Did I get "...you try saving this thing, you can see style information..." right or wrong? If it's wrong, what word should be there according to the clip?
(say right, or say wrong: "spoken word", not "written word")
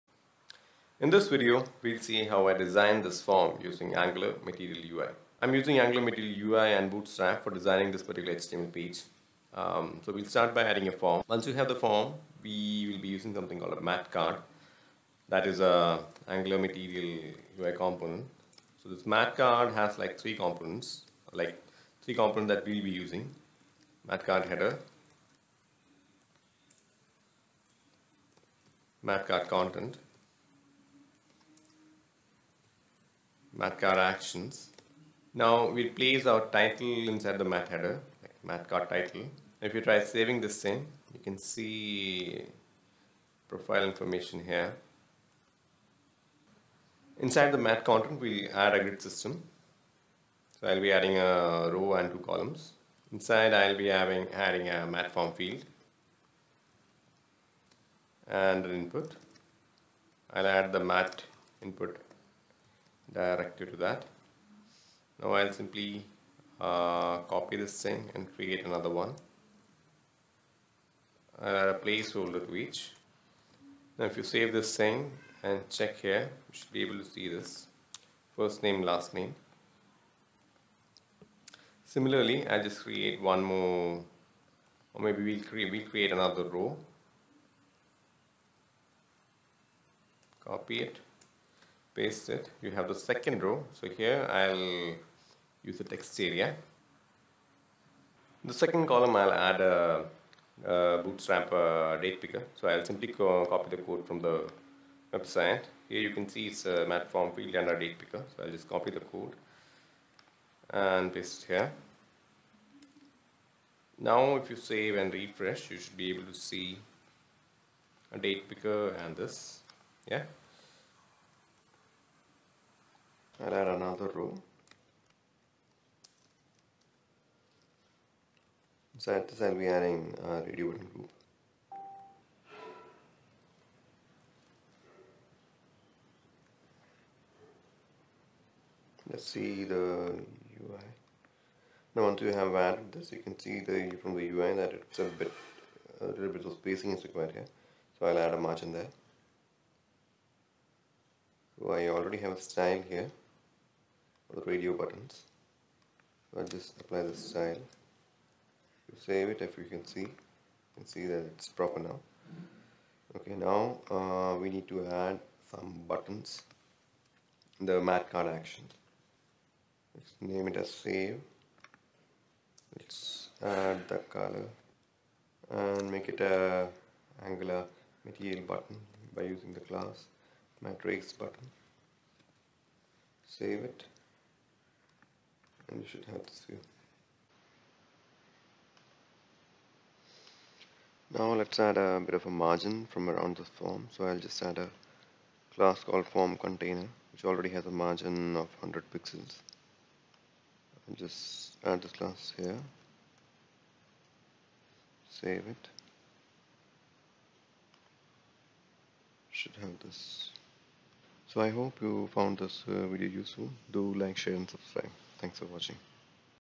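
wrong: "profile", not "style".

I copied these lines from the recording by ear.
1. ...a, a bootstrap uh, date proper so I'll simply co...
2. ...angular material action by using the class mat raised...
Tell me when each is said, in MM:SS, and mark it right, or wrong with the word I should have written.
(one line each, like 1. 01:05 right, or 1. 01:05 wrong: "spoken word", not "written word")
1. 01:39 wrong: "picker", not "proper"
2. 02:57 wrong: "button", not "action".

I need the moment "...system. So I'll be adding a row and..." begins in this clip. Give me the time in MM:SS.
00:48.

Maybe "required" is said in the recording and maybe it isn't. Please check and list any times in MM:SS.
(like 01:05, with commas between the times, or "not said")
02:27.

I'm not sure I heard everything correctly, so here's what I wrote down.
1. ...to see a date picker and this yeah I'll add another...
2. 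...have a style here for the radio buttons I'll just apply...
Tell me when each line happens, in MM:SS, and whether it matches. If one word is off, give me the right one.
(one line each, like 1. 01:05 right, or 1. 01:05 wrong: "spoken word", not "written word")
1. 01:56 right
2. 02:32 right.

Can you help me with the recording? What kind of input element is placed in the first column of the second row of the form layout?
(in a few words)
Text area.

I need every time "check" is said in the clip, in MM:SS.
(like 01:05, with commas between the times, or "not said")
01:15.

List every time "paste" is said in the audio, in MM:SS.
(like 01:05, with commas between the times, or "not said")
01:31, 01:51.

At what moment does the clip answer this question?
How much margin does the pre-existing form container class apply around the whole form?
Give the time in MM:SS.
03:18.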